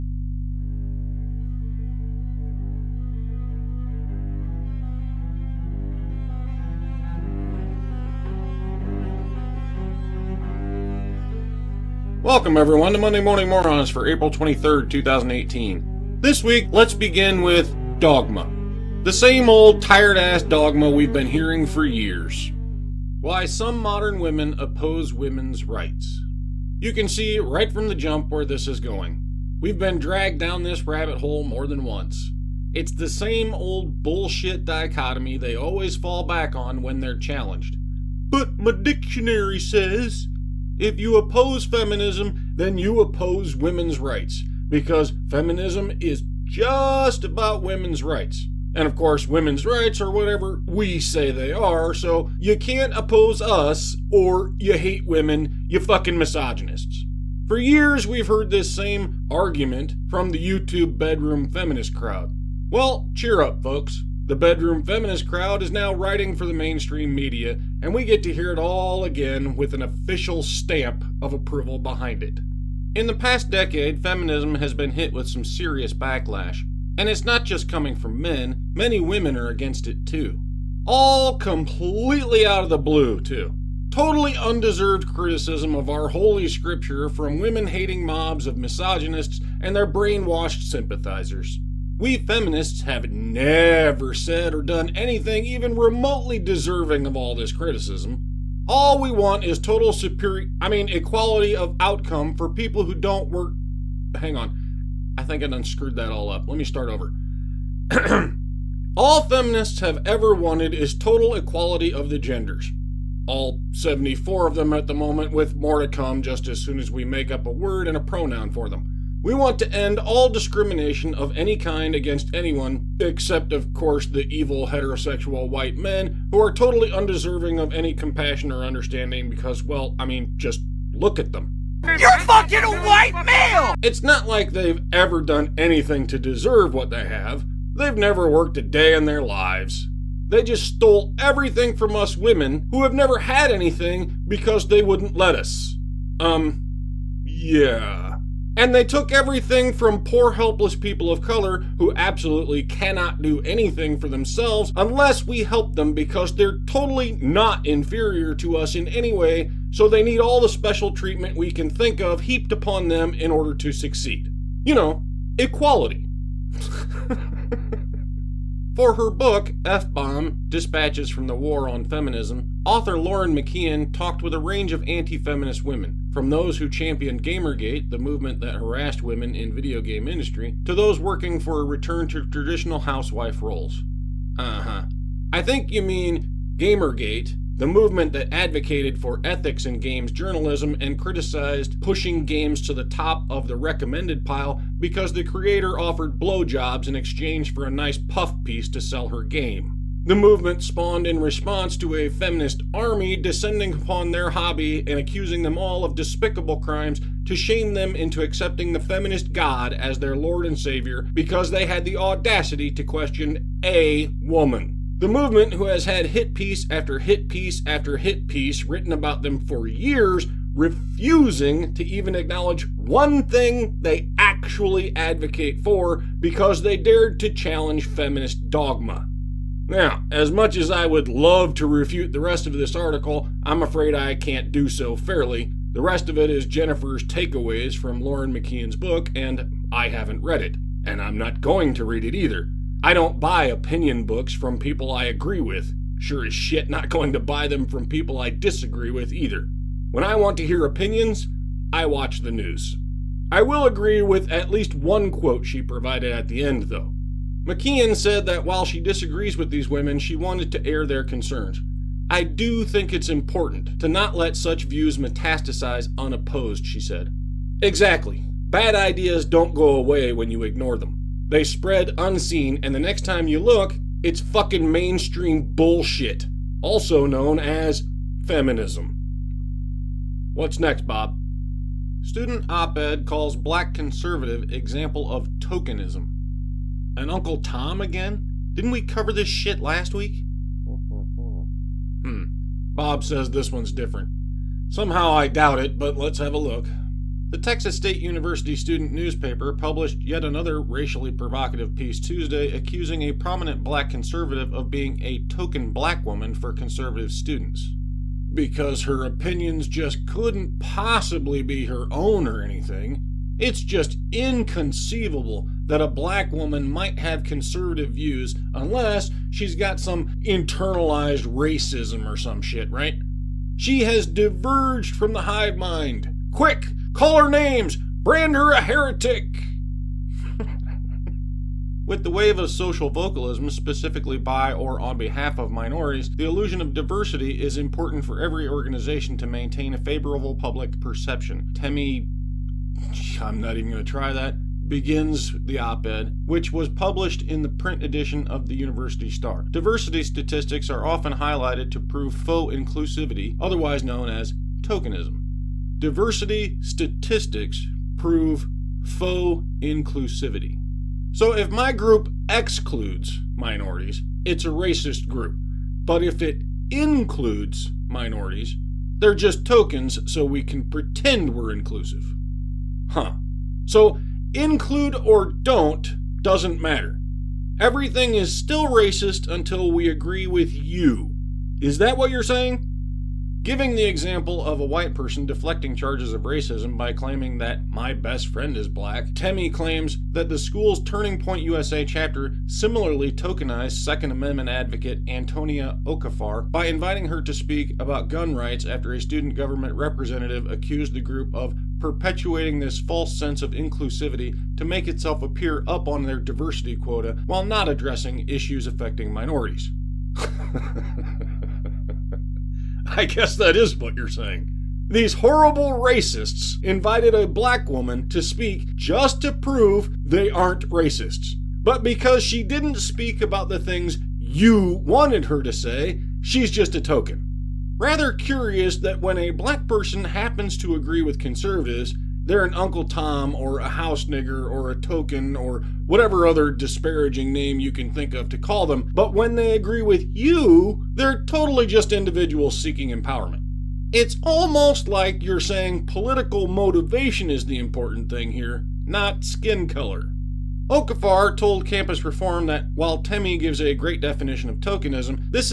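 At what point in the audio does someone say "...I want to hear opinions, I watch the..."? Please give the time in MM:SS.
04:10.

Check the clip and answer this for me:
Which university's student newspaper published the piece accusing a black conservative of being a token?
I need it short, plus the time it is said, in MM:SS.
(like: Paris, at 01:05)
Texas State University, at 04:57.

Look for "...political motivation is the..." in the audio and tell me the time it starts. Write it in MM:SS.
07:25.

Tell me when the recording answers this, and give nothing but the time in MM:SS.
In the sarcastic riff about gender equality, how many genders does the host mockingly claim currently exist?
01:53.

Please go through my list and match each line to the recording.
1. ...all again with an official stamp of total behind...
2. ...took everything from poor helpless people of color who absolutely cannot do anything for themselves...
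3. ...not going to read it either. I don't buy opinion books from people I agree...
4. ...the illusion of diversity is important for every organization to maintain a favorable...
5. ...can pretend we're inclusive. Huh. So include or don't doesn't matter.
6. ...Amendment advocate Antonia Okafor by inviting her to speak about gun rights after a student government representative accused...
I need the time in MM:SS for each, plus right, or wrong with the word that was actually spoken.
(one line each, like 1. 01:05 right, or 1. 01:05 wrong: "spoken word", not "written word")
1. 01:08 wrong: "approval", not "total"
2. 02:28 right
3. 04:01 right
4. 05:36 right
5. 06:10 right
6. 06:34 right.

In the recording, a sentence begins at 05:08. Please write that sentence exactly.
Because her opinions just couldn't possibly be her own or anything.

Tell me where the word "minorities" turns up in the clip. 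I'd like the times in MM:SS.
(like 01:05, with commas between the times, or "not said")
05:35, 06:03, 06:07, 06:49.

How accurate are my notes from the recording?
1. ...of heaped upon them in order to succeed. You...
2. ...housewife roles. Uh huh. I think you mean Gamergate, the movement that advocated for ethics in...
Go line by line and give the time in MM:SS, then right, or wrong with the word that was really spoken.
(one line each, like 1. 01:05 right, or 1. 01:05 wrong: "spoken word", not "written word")
1. 02:42 right
2. 03:02 right.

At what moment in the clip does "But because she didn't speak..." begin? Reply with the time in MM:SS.
07:01.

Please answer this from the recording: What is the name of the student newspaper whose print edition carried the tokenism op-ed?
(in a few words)
University Star.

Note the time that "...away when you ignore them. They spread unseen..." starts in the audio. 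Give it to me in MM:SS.
04:29.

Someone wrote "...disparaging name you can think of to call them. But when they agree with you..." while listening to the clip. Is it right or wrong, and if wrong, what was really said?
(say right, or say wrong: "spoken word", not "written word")
right.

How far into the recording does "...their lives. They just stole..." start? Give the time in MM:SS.
02:19.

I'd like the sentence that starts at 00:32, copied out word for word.
It's the same old bullshit dichotomy they always fall back on when they're challenged.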